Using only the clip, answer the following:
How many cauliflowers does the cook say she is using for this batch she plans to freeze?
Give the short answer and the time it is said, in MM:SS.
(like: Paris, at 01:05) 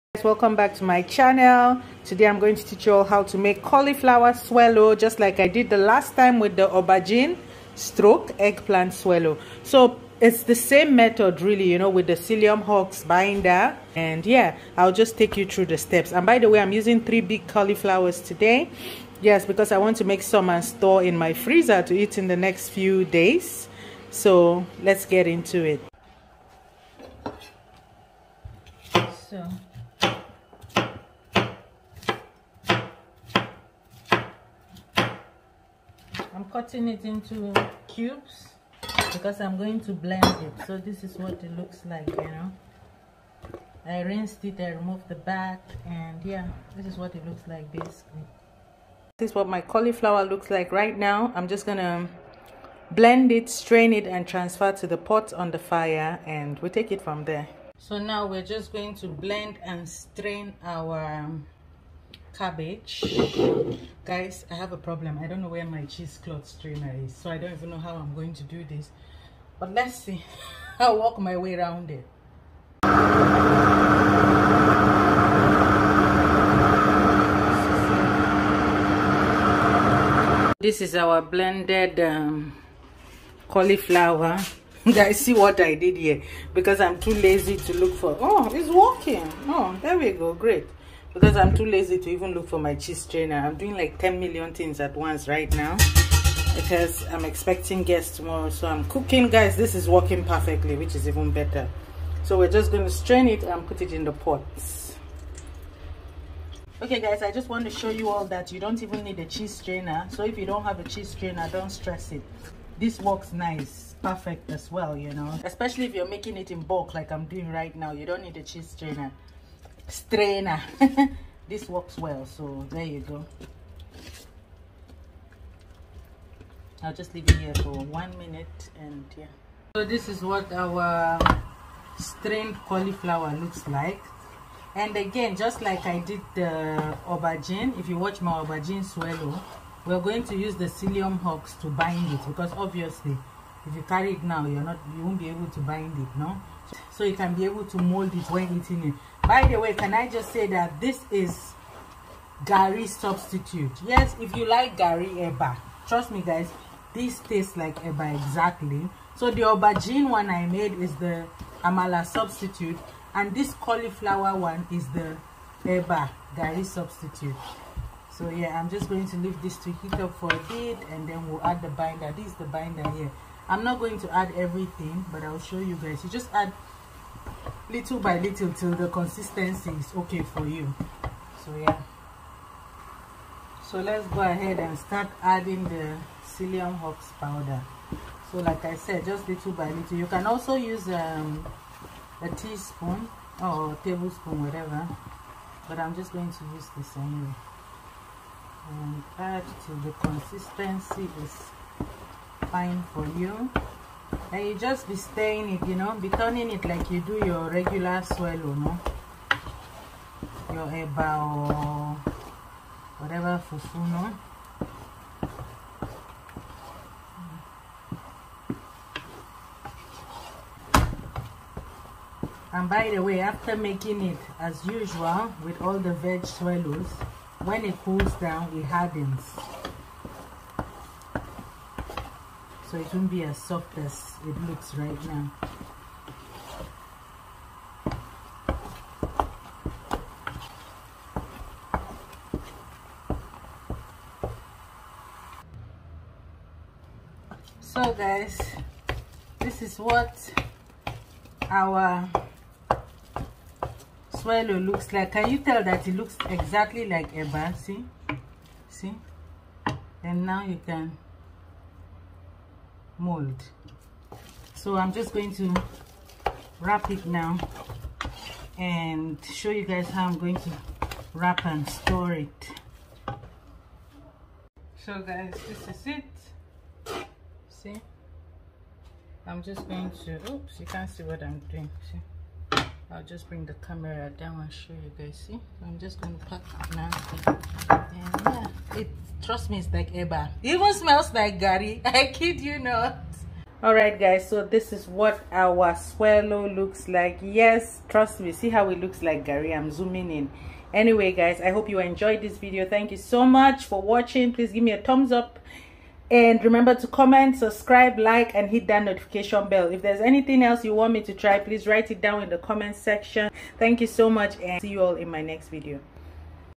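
3, at 00:17.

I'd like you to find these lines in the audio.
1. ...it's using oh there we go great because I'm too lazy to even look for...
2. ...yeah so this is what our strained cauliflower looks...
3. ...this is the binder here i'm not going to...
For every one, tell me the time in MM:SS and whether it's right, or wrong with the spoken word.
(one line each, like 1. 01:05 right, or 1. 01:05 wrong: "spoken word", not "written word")
1. 01:28 wrong: "working", not "using"
2. 02:09 right
3. 02:52 right.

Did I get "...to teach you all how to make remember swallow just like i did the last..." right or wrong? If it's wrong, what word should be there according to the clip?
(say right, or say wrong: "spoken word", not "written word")
wrong: "cauliflower", not "remember".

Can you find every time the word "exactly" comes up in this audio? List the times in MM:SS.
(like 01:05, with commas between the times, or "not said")
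02:38, 04:16.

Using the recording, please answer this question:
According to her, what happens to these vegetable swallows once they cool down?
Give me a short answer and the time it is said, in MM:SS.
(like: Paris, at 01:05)
it hardens, at 03:48.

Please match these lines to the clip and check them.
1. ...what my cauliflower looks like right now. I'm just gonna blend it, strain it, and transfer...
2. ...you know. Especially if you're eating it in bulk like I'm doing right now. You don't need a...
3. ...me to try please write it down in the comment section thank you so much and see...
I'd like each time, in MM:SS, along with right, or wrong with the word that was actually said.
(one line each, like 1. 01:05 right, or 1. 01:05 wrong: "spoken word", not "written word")
1. 00:49 right
2. 01:54 wrong: "making", not "eating"
3. 05:10 right.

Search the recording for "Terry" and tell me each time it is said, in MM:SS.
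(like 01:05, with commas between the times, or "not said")
not said.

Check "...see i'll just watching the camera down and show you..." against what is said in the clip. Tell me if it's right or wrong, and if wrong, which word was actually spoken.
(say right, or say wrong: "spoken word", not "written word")
wrong: "bring", not "watching".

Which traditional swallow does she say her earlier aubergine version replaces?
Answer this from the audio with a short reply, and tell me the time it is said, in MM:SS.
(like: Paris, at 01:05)
amala, at 02:41.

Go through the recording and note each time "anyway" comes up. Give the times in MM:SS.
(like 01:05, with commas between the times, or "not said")
03:16, 05:00.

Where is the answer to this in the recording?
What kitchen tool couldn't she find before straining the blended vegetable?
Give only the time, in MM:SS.
01:05.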